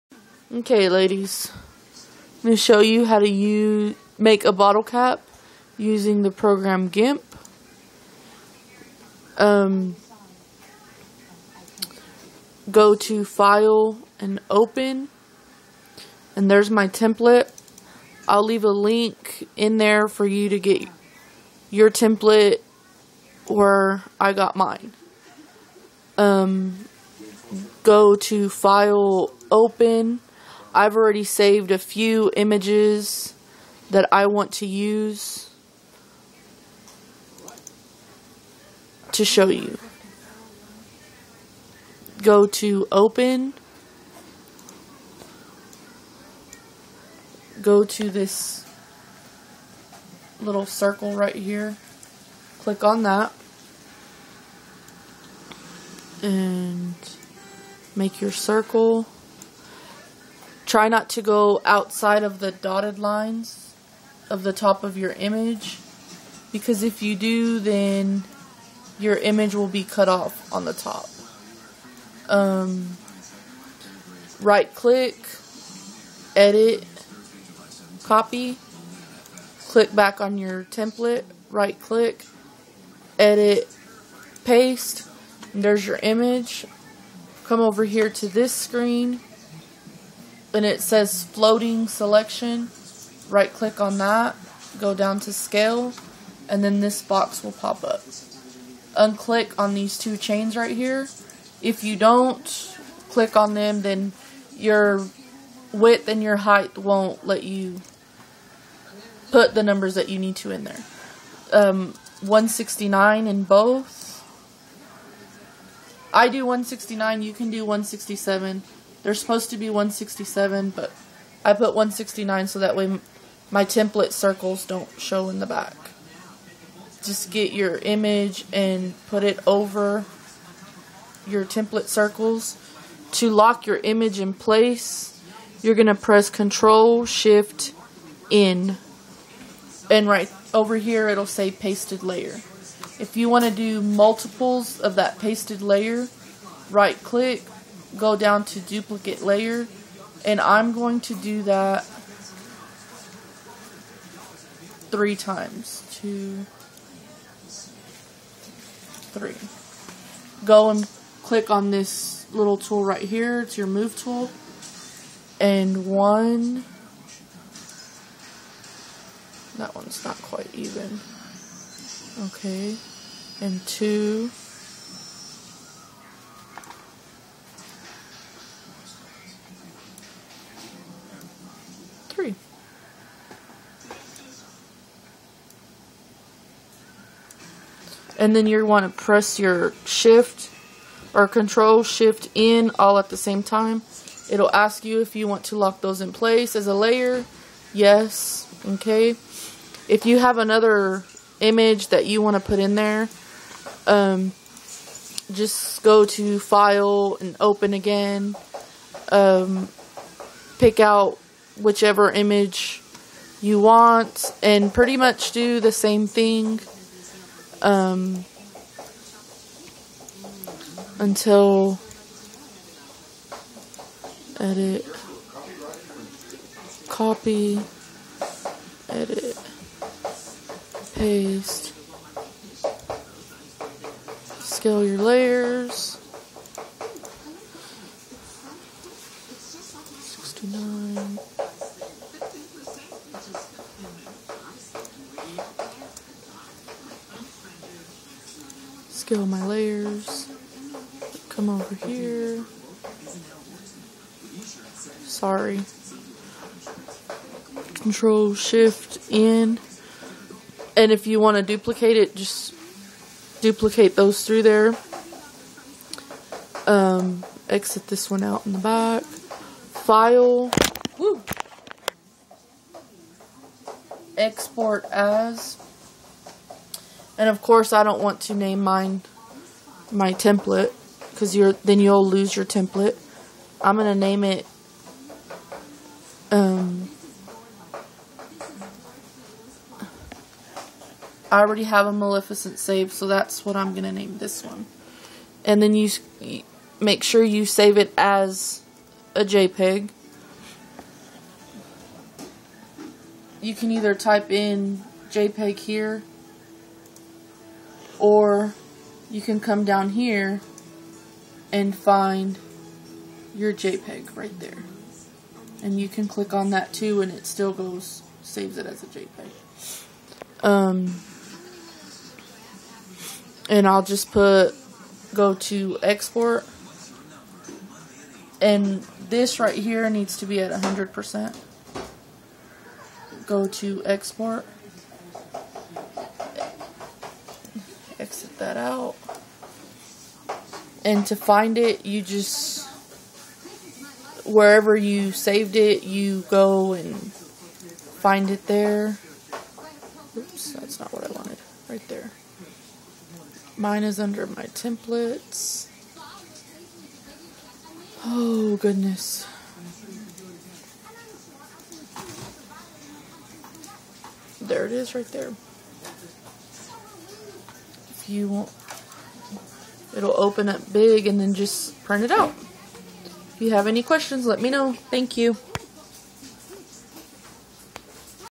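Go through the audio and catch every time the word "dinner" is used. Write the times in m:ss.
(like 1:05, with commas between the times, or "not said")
not said.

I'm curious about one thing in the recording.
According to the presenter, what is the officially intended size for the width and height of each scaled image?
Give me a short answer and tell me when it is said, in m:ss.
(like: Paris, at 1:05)
167, at 1:59.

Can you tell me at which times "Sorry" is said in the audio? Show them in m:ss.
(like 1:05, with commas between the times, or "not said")
4:15.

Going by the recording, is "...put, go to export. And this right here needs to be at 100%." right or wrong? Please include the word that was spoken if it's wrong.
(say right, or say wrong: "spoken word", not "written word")
right.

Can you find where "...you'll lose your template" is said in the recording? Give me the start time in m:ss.
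4:41.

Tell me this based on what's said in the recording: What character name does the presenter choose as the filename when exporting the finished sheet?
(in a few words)
Maleficent.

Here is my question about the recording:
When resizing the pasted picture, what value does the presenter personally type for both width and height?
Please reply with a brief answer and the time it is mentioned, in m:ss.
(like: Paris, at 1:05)
169, at 1:56.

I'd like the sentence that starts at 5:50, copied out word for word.
Oops, that's not what I wanted.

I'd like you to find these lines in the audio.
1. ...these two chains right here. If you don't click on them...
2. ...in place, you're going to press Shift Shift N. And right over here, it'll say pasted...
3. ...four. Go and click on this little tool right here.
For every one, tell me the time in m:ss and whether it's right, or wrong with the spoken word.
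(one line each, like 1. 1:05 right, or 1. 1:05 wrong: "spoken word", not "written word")
1. 1:39 right
2. 2:14 wrong: "Control", not "Shift"
3. 2:39 wrong: "three", not "four".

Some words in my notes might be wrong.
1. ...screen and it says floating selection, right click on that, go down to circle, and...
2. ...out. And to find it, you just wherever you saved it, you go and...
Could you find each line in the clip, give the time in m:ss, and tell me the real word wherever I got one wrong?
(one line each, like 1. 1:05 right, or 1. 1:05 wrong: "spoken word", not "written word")
1. 1:28 wrong: "scale", not "circle"
2. 5:38 right.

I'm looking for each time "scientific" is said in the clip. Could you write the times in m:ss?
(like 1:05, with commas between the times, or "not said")
not said.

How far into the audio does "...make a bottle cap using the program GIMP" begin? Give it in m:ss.
0:04.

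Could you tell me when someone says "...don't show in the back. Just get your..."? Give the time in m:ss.
2:04.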